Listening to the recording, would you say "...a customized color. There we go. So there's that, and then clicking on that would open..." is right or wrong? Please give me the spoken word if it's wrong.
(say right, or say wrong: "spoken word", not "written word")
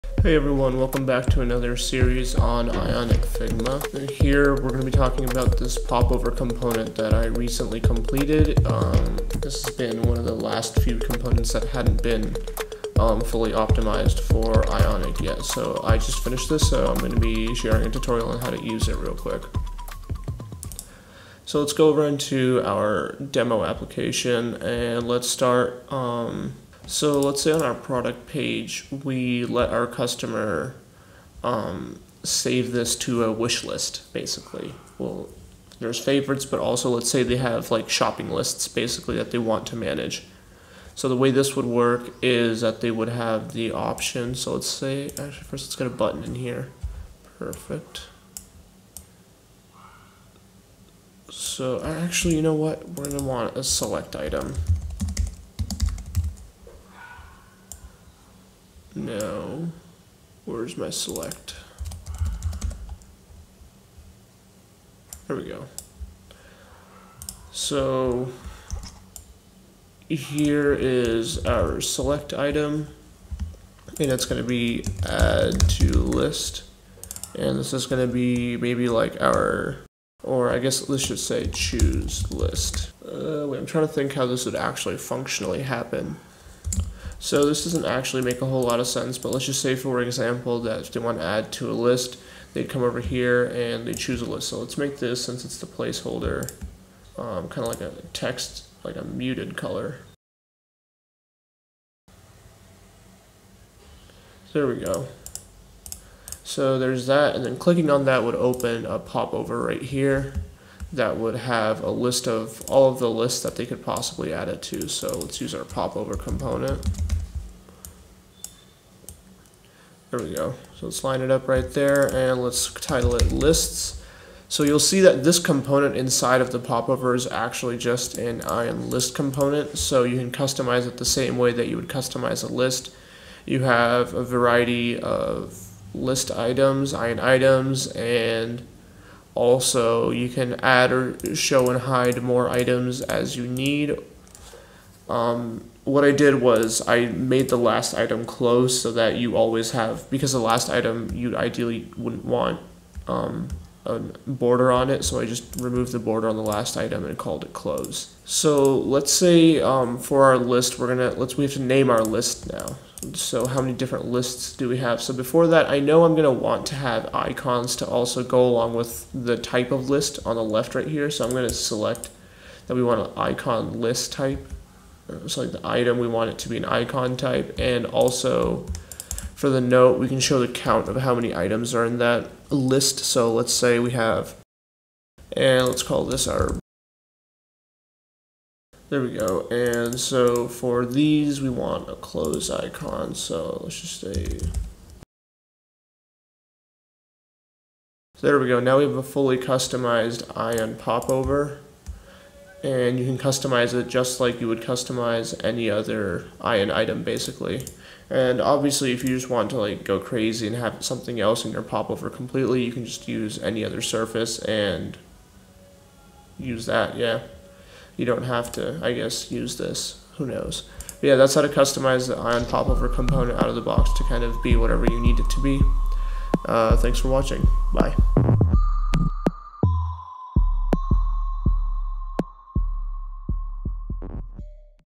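wrong: "muted", not "customized".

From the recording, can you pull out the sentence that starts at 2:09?
So you can customize it the same way that you would customize a list.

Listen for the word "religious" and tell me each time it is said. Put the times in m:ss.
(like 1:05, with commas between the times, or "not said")
not said.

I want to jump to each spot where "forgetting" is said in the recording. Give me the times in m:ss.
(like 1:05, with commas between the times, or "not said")
not said.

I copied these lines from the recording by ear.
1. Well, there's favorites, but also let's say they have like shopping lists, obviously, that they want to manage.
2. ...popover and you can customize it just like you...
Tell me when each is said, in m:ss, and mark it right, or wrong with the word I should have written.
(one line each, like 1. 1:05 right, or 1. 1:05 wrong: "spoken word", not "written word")
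1. 0:34 wrong: "basically", not "obviously"
2. 3:20 right.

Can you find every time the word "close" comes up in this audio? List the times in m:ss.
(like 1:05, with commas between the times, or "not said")
2:28, 2:37, 3:11.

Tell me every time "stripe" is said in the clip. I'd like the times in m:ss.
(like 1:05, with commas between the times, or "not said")
not said.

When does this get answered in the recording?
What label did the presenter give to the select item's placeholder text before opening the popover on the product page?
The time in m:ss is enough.
1:21.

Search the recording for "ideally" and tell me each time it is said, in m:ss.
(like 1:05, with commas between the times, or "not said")
2:31.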